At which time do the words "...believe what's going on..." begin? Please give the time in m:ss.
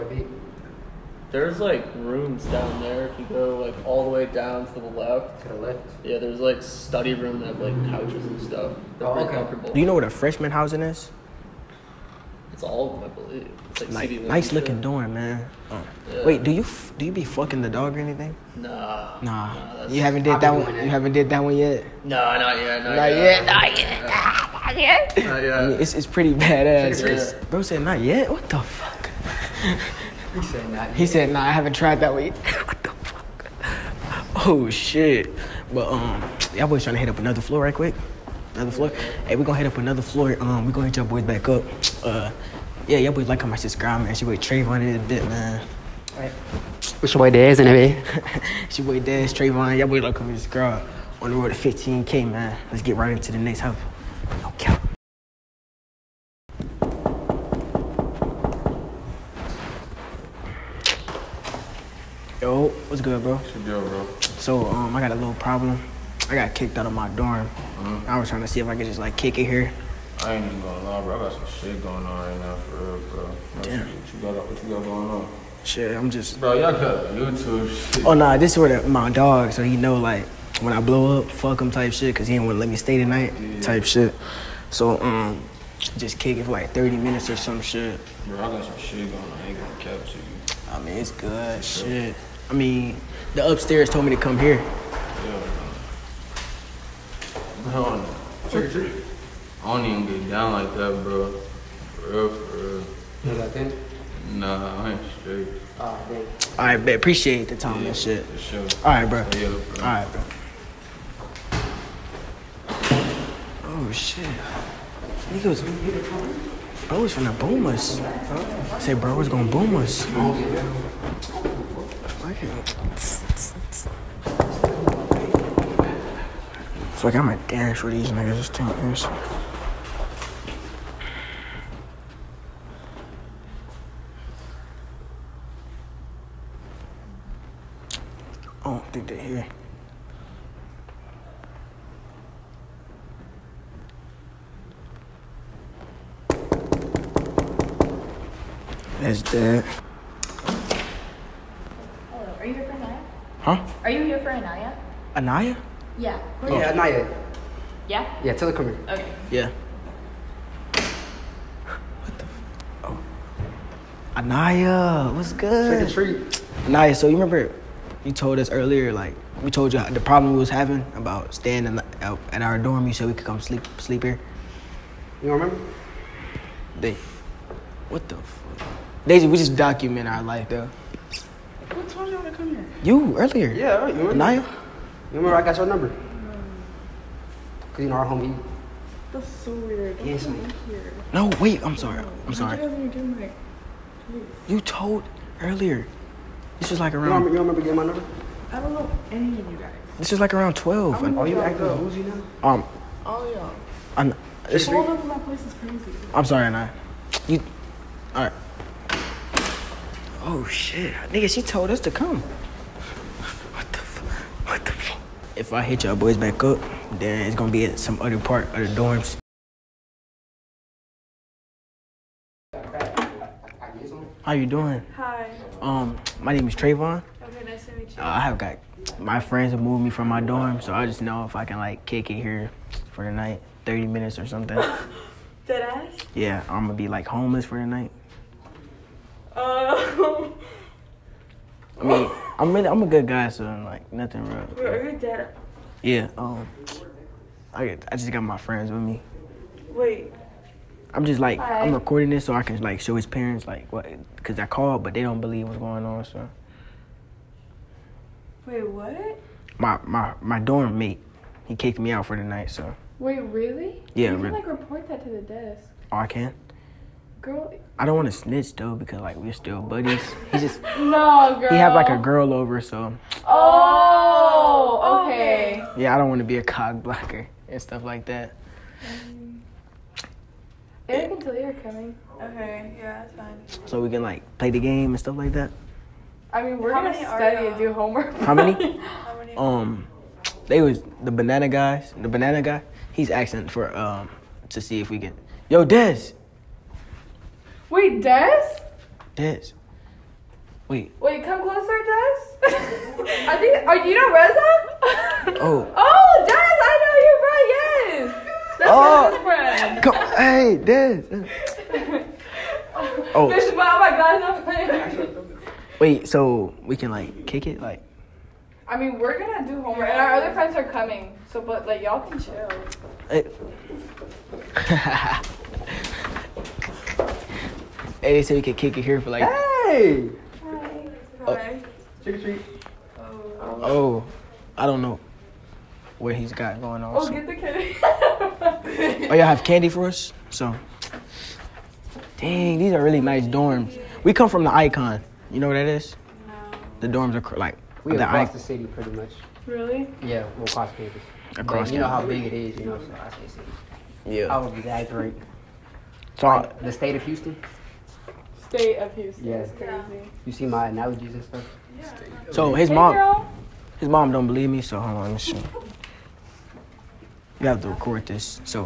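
4:15.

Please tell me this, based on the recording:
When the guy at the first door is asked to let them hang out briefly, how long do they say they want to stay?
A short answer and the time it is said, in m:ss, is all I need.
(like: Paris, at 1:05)
30 minutes, at 1:26.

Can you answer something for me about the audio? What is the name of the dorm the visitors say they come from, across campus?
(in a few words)
the Icon.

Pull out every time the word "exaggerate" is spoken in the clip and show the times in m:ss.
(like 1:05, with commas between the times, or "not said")
5:54.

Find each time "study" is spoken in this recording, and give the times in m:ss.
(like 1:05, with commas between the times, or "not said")
0:06, 4:46.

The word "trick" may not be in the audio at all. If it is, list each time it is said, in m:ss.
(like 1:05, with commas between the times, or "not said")
1:38, 2:45, 5:32.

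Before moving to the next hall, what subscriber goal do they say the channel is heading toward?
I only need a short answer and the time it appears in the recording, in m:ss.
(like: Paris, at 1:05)
15k, at 0:51.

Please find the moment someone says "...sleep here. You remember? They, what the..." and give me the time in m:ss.
2:53.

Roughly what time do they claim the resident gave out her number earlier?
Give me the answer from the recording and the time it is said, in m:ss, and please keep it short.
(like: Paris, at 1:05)
12, at 3:20.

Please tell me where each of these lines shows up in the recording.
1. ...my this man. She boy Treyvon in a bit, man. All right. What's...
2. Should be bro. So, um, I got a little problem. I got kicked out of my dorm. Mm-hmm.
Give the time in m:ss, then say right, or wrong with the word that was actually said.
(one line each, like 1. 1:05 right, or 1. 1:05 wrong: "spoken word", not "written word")
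1. 0:43 right
2. 1:03 right.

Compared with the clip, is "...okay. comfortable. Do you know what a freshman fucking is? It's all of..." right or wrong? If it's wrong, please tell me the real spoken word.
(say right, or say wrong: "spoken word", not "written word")
wrong: "housing", not "fucking".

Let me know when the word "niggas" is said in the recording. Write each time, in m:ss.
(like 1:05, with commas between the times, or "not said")
1:55, 2:08, 3:31.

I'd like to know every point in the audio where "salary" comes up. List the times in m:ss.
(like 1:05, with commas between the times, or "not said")
not said.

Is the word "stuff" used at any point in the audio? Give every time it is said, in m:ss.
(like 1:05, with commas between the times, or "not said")
0:08, 4:37, 4:44, 6:01.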